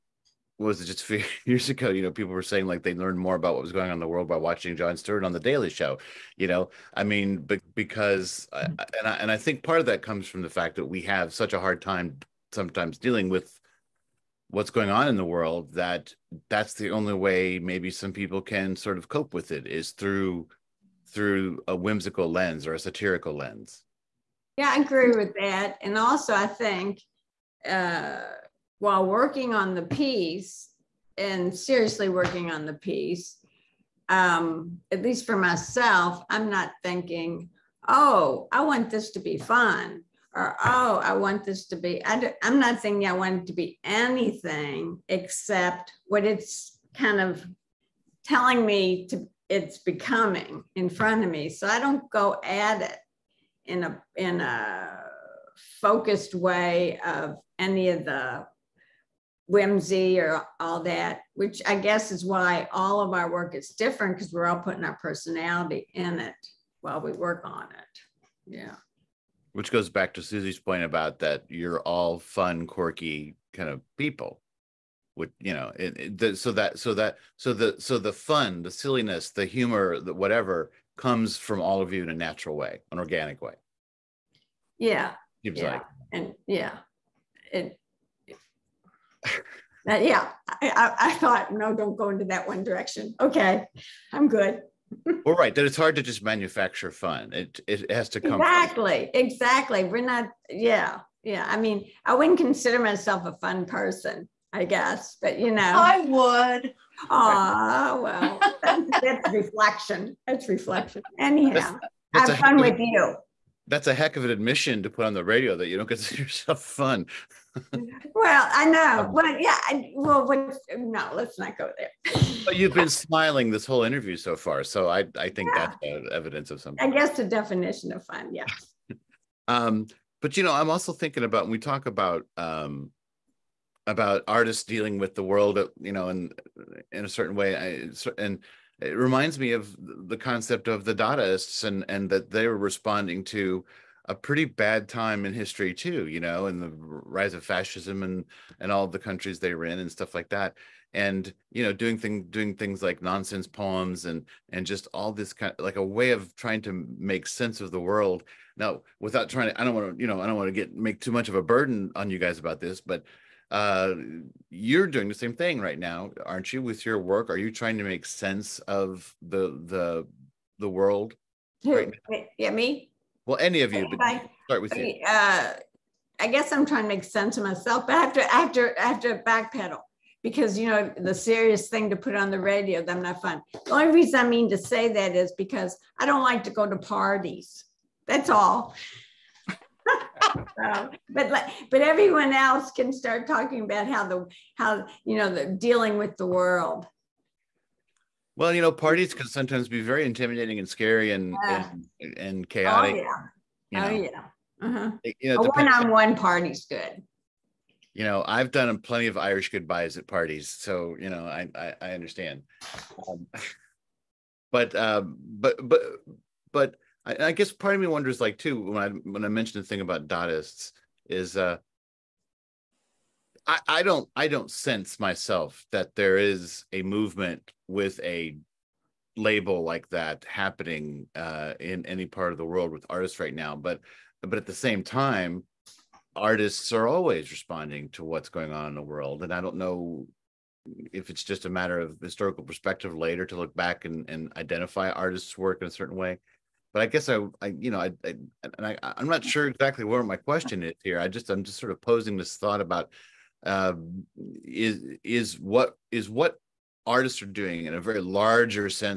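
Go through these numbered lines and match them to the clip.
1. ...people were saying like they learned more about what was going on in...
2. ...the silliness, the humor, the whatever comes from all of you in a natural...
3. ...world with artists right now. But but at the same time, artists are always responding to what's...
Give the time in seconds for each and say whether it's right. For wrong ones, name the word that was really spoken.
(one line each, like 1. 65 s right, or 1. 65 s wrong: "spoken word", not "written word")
1. 2 s right
2. 78 s right
3. 232 s right.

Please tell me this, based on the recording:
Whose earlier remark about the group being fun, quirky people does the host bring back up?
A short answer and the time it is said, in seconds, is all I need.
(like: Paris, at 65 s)
Suzi, at 70 s.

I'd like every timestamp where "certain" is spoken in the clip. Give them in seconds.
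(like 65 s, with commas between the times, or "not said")
137 s, 245 s.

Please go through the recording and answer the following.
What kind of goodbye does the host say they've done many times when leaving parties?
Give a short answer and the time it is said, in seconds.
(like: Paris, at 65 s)
Irish goodbyes, at 209 s.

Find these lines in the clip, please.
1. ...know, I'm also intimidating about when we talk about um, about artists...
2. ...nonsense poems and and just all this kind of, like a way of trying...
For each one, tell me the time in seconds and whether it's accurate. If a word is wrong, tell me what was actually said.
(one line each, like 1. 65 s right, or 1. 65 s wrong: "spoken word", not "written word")
1. 130 s wrong: "thinking", not "intimidating"
2. 153 s right.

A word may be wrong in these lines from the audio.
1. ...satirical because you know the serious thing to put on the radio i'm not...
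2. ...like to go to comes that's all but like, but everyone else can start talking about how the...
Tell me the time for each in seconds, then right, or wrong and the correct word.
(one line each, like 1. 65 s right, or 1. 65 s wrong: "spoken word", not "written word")
1. 179 s wrong: "backpedal", not "satirical"
2. 186 s wrong: "parties", not "comes".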